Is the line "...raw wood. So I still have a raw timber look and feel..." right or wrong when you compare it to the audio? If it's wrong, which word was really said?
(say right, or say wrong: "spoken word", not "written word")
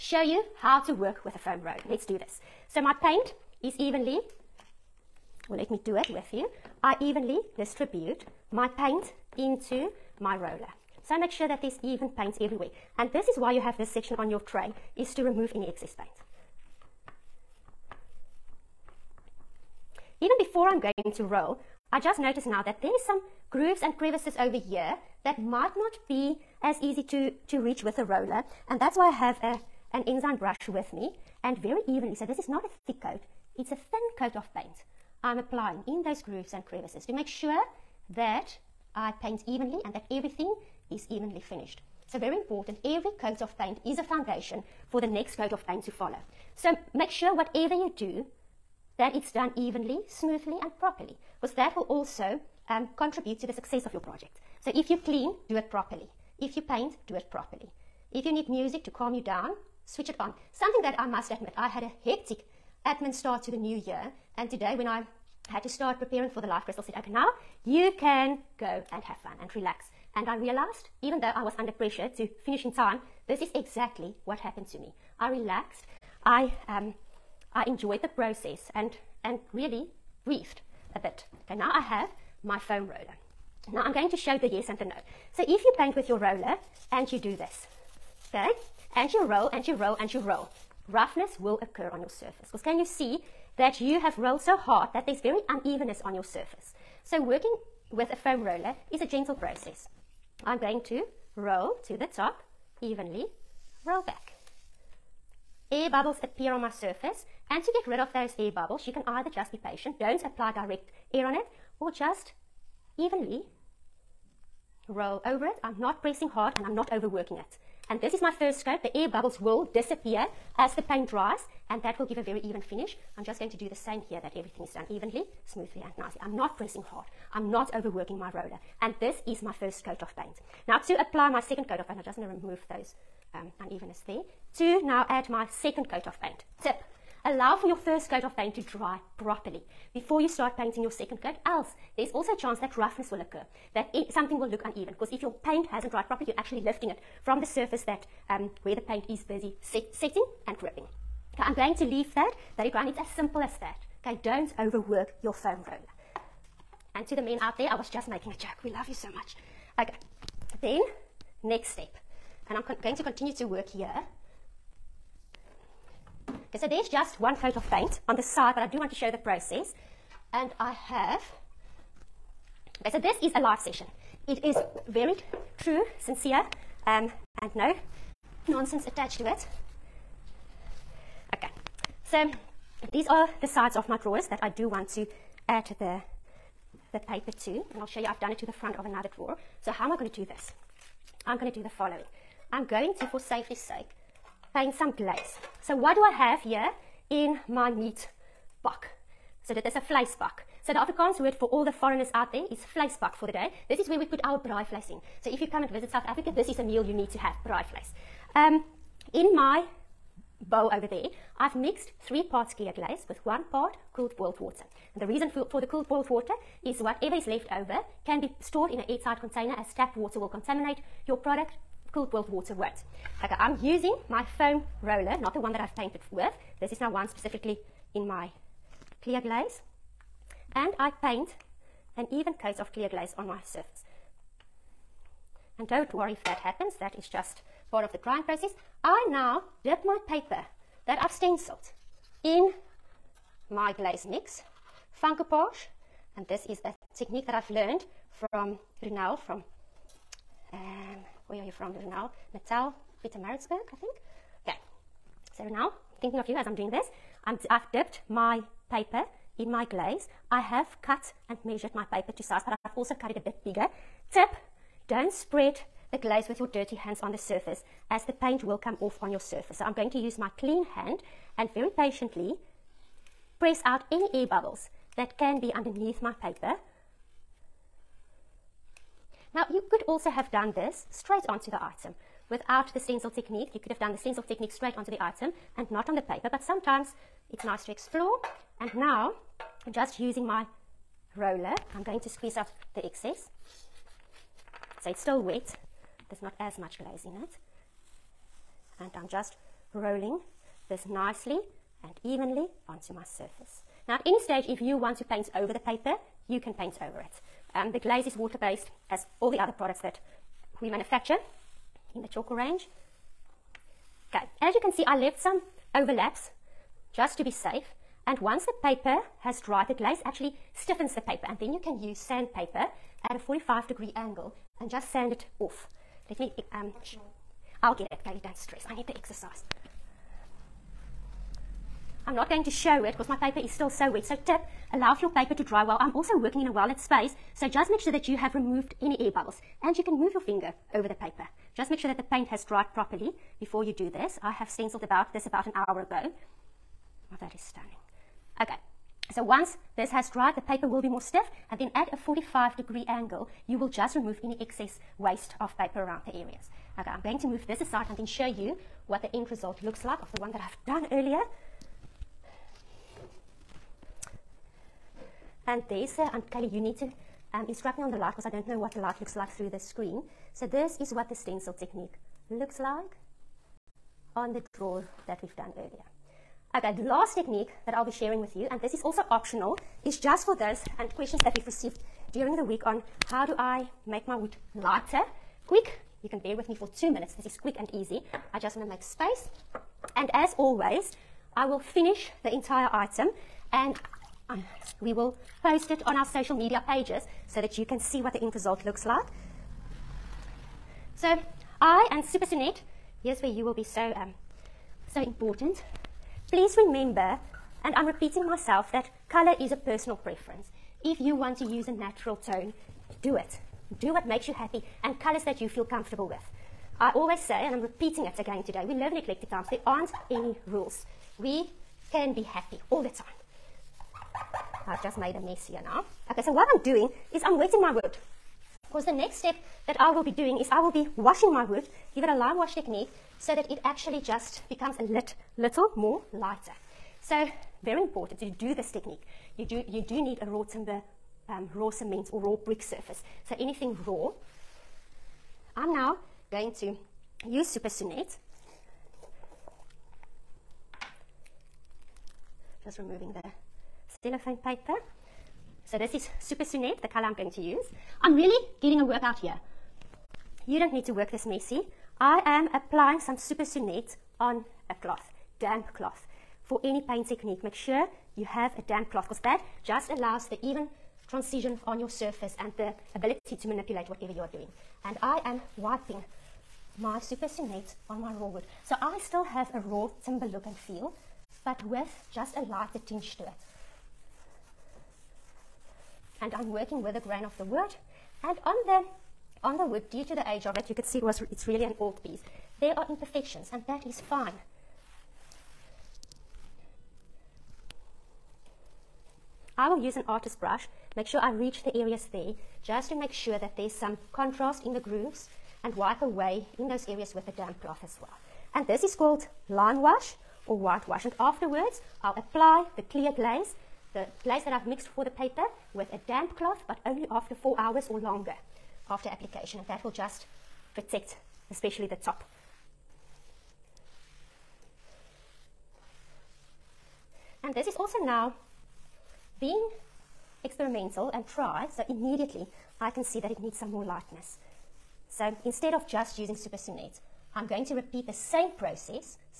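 right.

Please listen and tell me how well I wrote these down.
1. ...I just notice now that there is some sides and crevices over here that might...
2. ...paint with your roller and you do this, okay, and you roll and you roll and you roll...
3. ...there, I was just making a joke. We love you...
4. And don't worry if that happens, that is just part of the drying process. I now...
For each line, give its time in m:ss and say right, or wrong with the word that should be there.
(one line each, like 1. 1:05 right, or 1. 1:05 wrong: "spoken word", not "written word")
1. 0:21 wrong: "grooves", not "sides"
2. 1:25 right
3. 2:37 right
4. 3:55 right.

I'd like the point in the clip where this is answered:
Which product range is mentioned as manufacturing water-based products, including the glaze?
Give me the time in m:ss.
5:12.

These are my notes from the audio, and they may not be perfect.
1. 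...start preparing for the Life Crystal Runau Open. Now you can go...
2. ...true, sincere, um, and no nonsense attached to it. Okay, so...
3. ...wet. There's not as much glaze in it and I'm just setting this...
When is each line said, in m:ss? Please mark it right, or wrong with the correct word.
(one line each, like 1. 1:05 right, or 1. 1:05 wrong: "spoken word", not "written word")
1. 1:05 wrong: "Set", not "Runau"
2. 2:55 right
3. 4:55 wrong: "rolling", not "setting".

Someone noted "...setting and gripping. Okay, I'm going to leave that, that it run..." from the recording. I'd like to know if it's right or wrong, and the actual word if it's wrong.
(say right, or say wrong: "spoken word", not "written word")
right.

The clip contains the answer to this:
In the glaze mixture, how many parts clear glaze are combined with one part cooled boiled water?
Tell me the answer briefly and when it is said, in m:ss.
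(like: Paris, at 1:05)
3, at 3:32.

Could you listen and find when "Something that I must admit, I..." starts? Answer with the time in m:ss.
1:00.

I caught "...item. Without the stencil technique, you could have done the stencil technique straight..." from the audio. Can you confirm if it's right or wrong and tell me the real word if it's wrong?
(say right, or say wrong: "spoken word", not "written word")
right.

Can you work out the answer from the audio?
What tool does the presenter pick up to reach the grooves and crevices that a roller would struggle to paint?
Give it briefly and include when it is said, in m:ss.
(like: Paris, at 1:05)
enzyme brush, at 0:30.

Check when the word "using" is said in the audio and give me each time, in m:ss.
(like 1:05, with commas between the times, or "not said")
3:43, 4:49, 8:56.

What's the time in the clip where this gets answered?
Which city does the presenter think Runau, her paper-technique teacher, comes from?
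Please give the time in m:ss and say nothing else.
4:13.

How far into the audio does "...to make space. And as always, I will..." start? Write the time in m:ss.
6:28.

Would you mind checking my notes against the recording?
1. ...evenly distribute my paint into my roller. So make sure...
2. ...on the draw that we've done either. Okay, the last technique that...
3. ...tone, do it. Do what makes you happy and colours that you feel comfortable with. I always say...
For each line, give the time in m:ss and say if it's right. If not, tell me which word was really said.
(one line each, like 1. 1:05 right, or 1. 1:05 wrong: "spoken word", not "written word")
1. 0:06 right
2. 6:14 wrong: "earlier", not "either"
3. 6:52 right.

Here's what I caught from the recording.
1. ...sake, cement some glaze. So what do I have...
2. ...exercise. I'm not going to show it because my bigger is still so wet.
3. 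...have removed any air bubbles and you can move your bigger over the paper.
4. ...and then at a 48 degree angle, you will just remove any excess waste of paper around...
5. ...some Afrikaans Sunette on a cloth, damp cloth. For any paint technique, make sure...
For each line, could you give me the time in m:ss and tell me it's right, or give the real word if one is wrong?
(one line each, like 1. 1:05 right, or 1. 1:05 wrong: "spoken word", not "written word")
1. 3:13 wrong: "paint", not "cement"
2. 5:28 wrong: "paper", not "bigger"
3. 5:38 wrong: "finger", not "bigger"
4. 5:51 wrong: "45", not "48"
5. 7:42 wrong: "Super", not "Afrikaans".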